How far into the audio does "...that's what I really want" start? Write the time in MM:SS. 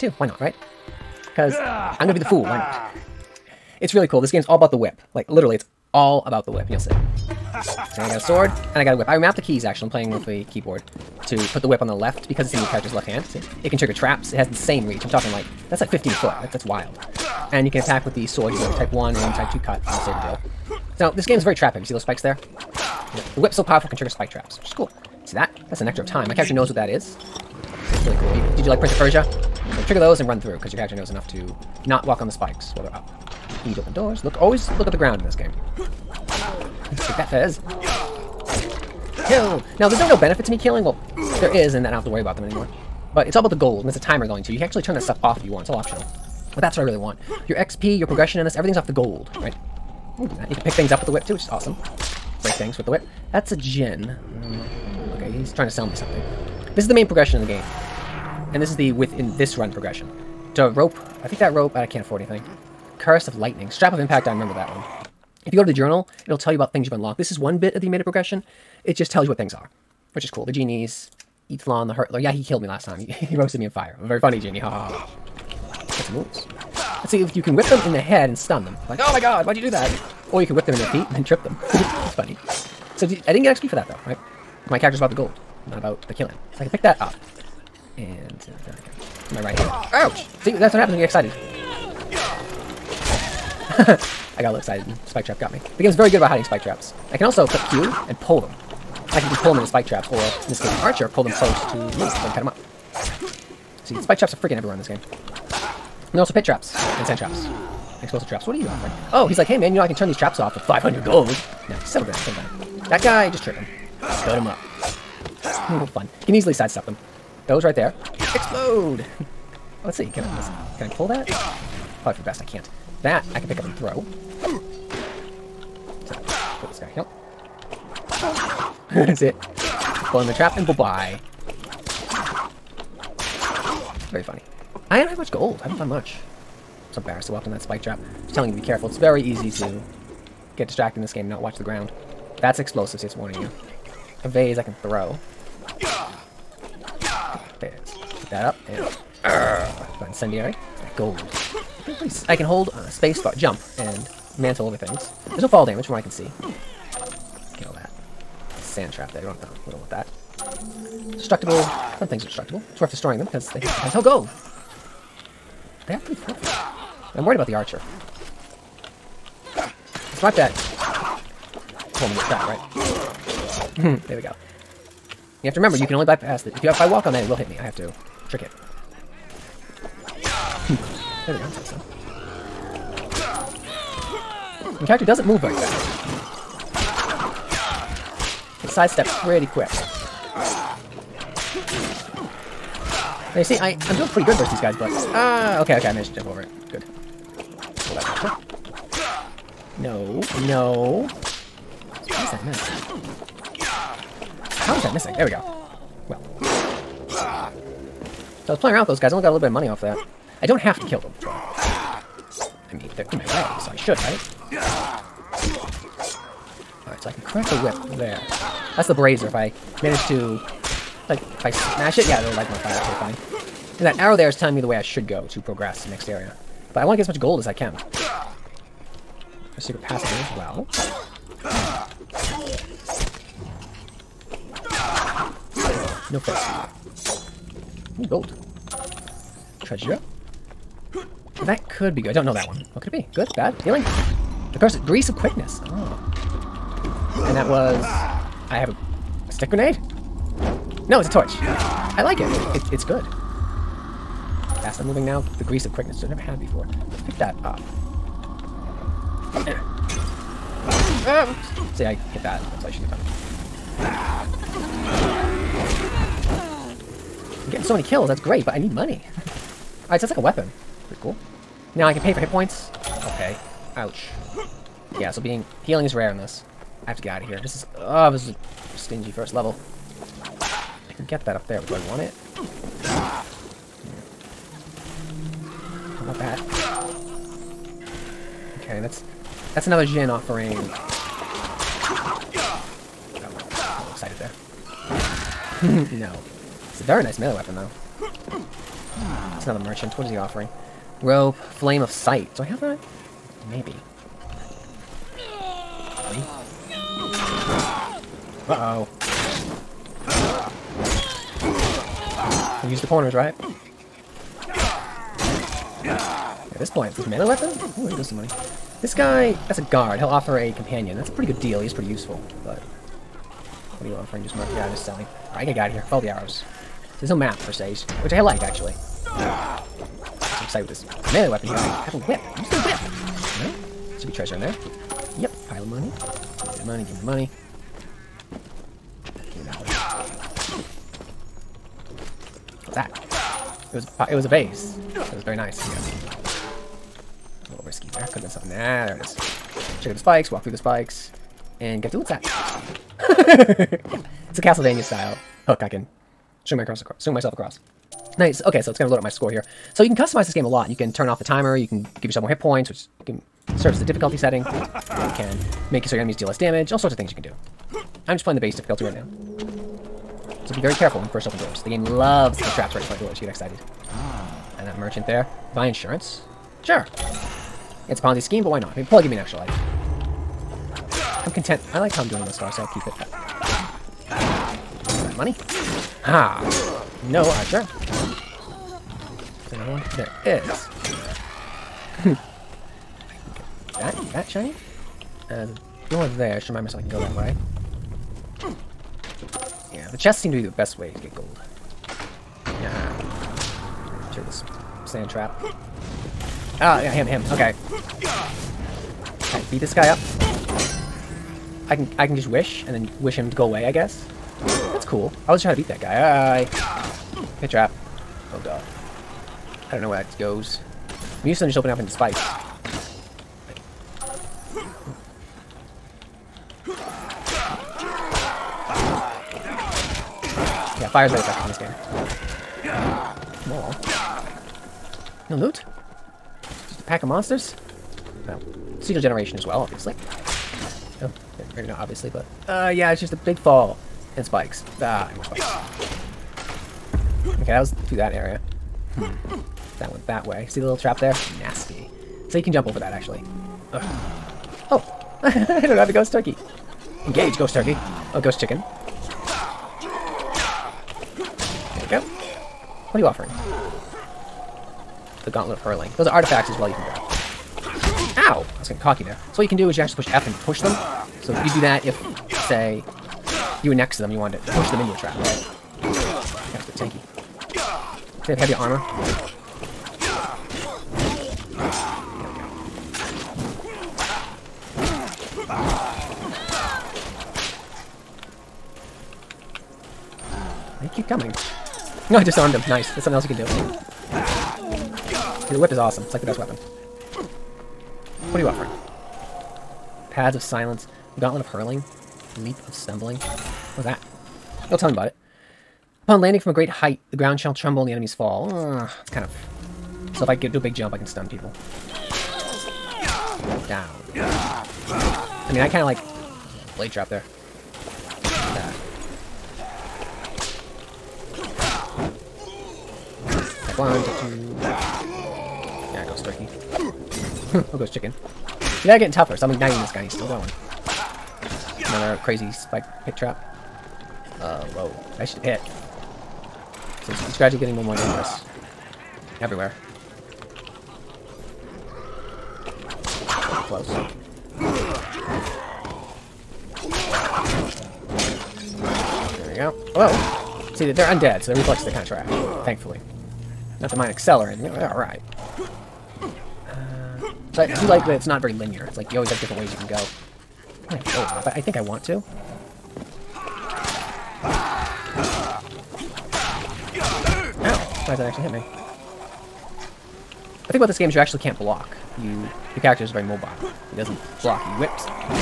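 00:46.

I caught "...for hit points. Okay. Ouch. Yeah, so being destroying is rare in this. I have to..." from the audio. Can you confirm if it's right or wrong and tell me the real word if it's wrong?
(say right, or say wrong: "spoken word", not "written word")
wrong: "healing", not "destroying".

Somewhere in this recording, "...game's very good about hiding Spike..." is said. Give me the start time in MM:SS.
01:35.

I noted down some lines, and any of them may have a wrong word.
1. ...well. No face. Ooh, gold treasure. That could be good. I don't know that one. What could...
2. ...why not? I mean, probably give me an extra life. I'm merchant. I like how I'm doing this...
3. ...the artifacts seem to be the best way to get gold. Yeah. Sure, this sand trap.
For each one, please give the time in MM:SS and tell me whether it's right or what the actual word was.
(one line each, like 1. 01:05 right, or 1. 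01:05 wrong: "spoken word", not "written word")
1. 03:50 right
2. 06:18 wrong: "content", not "merchant"
3. 06:39 wrong: "chests", not "artifacts".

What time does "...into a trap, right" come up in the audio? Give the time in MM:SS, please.
07:54.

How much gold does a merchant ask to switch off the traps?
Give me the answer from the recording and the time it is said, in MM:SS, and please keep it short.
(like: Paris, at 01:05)
500, at 01:50.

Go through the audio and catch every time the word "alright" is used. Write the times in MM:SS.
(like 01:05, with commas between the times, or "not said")
04:29, 05:25, 09:14.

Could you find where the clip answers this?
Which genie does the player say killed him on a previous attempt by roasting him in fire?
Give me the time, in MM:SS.
01:11.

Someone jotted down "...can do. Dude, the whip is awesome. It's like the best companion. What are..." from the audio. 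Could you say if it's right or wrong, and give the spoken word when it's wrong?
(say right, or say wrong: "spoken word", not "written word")
wrong: "weapon", not "companion".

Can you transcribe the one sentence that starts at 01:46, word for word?
And also pit traps and sand traps.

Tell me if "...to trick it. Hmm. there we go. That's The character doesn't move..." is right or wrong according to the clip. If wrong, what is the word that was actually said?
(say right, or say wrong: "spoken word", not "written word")
right.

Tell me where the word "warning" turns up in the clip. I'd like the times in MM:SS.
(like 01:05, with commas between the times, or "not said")
02:23.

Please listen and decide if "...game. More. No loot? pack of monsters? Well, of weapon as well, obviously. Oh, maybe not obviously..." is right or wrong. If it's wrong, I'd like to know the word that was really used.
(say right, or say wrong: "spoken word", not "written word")
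wrong: "generation", not "weapon".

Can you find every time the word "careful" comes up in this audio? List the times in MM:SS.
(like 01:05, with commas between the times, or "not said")
02:18, 06:10.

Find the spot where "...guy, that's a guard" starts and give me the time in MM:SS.
05:18.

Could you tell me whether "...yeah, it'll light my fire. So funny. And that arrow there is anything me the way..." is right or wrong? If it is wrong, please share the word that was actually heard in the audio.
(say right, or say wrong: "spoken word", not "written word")
wrong: "telling", not "anything".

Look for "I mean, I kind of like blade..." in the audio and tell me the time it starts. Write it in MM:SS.
08:34.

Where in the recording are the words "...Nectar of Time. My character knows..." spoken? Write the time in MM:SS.
00:25.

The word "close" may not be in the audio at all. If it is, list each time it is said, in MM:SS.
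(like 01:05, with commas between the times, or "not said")
01:41, 09:03.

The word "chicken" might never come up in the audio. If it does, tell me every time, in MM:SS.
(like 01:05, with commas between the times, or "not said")
07:38, 08:47.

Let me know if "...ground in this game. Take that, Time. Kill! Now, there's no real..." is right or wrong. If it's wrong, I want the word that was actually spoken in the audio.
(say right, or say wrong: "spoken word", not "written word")
wrong: "Fez", not "Time".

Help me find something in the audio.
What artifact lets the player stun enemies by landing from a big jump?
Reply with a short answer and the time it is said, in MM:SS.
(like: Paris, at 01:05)
Leap of Stumbling, at 08:22.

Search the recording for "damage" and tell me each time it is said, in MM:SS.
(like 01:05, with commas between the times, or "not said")
02:35, 06:06.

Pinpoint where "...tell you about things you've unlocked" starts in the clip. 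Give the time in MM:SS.
01:06.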